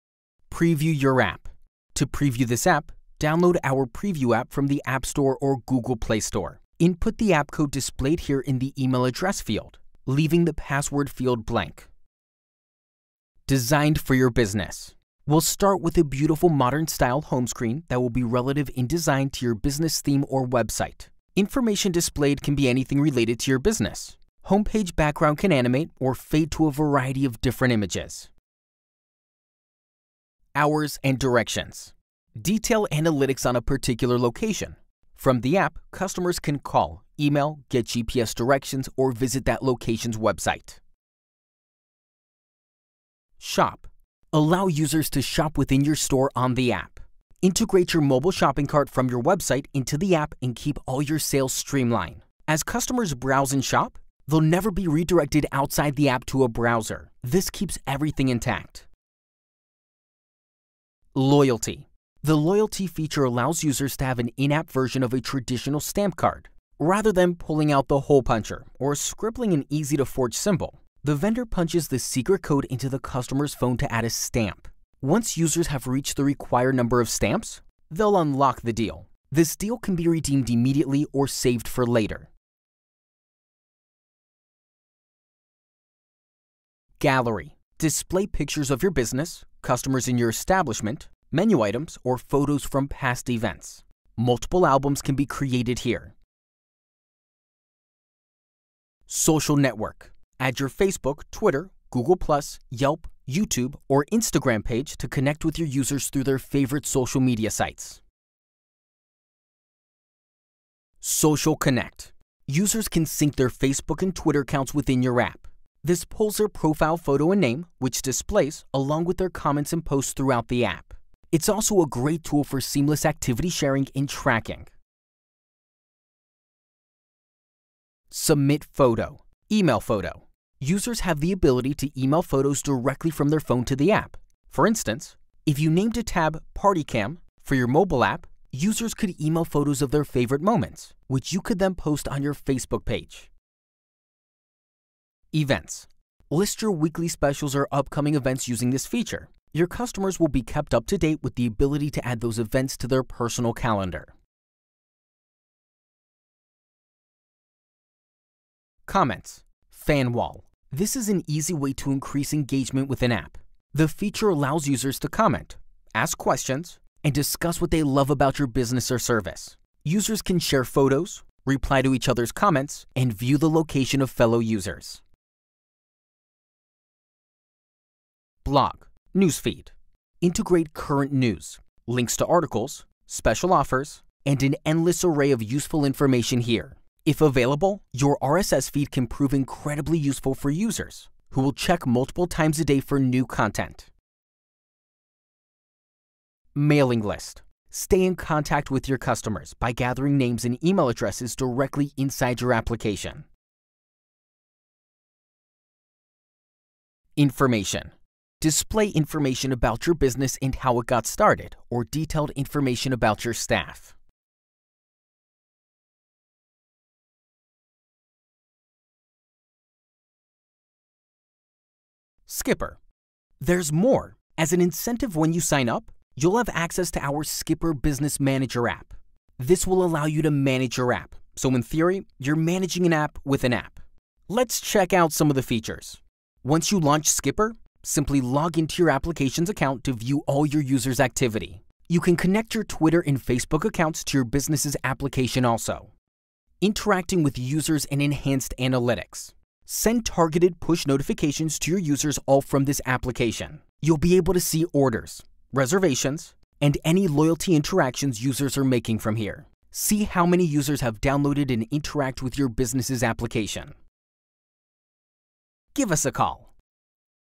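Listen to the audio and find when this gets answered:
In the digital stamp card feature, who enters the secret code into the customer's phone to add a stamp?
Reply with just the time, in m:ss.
1:11.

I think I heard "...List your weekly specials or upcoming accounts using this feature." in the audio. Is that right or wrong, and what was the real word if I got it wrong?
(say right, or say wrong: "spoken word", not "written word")
wrong: "events", not "accounts".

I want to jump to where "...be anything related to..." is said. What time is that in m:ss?
0:22.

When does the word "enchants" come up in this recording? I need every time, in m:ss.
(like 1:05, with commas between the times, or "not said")
not said.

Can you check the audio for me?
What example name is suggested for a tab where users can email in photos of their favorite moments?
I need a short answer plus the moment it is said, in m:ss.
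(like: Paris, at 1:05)
Party Cam, at 2:16.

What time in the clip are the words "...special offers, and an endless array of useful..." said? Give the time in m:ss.
3:03.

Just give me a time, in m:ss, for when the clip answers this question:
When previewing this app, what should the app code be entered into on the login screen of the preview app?
0:08.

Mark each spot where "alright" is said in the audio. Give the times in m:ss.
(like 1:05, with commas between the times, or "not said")
not said.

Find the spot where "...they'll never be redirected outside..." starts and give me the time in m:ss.
0:54.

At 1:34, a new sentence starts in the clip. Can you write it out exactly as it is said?
Multiple albums can be created here.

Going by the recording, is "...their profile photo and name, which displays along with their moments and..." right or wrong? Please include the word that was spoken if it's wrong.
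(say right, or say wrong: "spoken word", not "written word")
wrong: "comments", not "moments".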